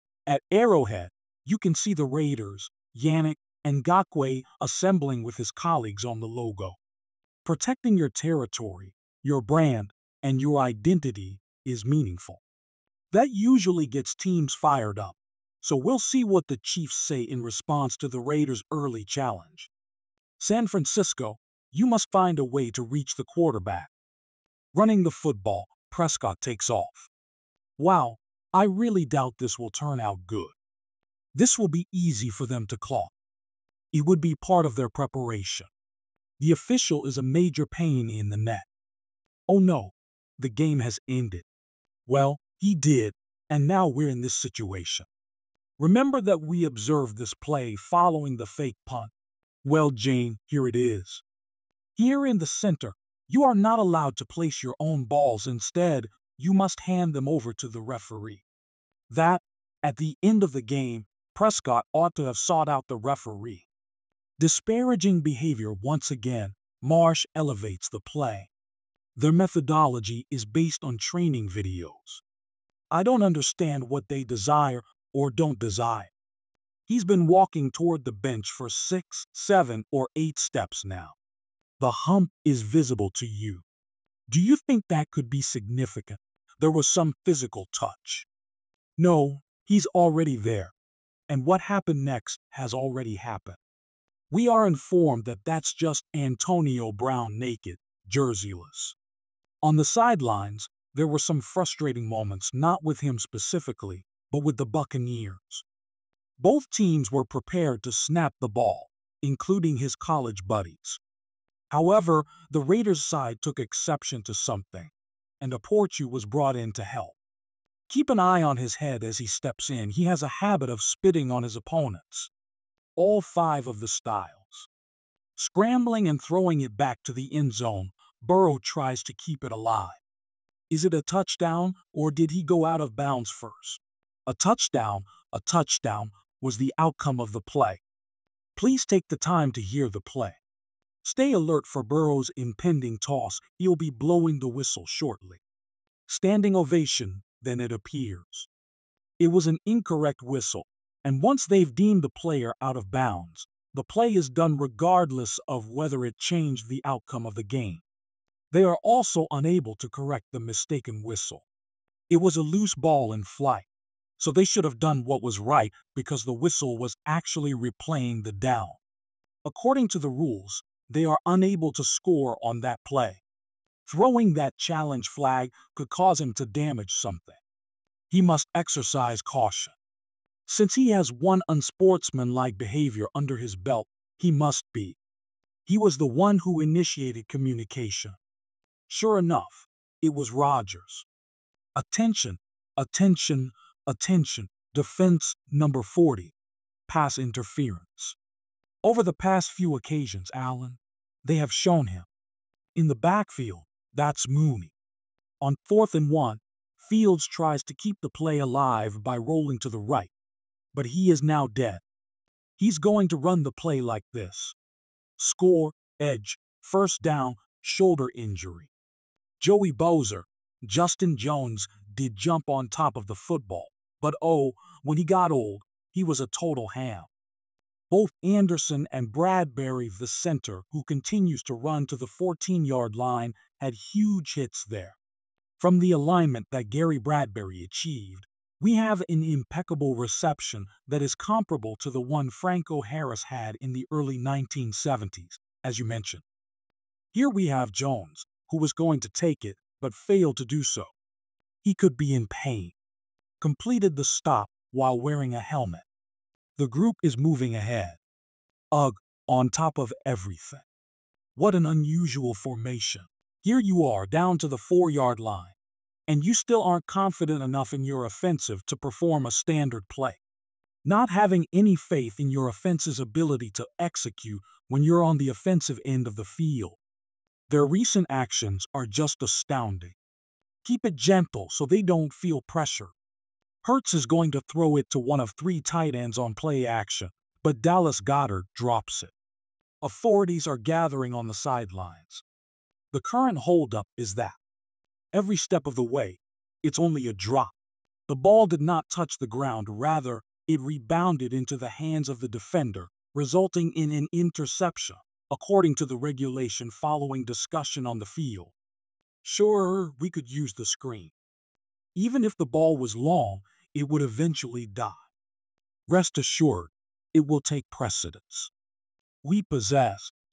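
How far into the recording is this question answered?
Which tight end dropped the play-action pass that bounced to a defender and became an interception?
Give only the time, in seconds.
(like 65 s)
287 s.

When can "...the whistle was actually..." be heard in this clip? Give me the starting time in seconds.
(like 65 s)
166 s.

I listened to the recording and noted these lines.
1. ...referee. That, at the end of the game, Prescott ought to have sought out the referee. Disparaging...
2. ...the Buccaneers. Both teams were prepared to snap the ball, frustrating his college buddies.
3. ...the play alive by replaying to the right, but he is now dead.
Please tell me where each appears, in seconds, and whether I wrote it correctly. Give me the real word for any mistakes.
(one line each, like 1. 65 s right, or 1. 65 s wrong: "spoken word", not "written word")
1. 57 s right
2. 104 s wrong: "including", not "frustrating"
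3. 208 s wrong: "rolling", not "replaying".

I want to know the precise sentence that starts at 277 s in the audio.
Their recent actions are just astounding.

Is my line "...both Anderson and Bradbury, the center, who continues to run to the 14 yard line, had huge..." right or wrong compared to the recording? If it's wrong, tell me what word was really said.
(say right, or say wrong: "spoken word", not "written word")
right.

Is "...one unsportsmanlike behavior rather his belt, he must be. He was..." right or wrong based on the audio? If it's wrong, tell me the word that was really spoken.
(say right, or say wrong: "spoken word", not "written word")
wrong: "under", not "rather".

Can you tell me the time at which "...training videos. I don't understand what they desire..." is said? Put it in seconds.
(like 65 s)
70 s.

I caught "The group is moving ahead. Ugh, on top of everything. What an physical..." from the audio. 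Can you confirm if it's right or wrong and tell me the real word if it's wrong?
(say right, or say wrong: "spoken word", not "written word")
wrong: "unusual", not "physical".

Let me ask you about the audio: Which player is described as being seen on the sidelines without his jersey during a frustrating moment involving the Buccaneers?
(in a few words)
Antonio Brown.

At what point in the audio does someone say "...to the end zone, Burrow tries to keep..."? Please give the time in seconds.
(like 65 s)
127 s.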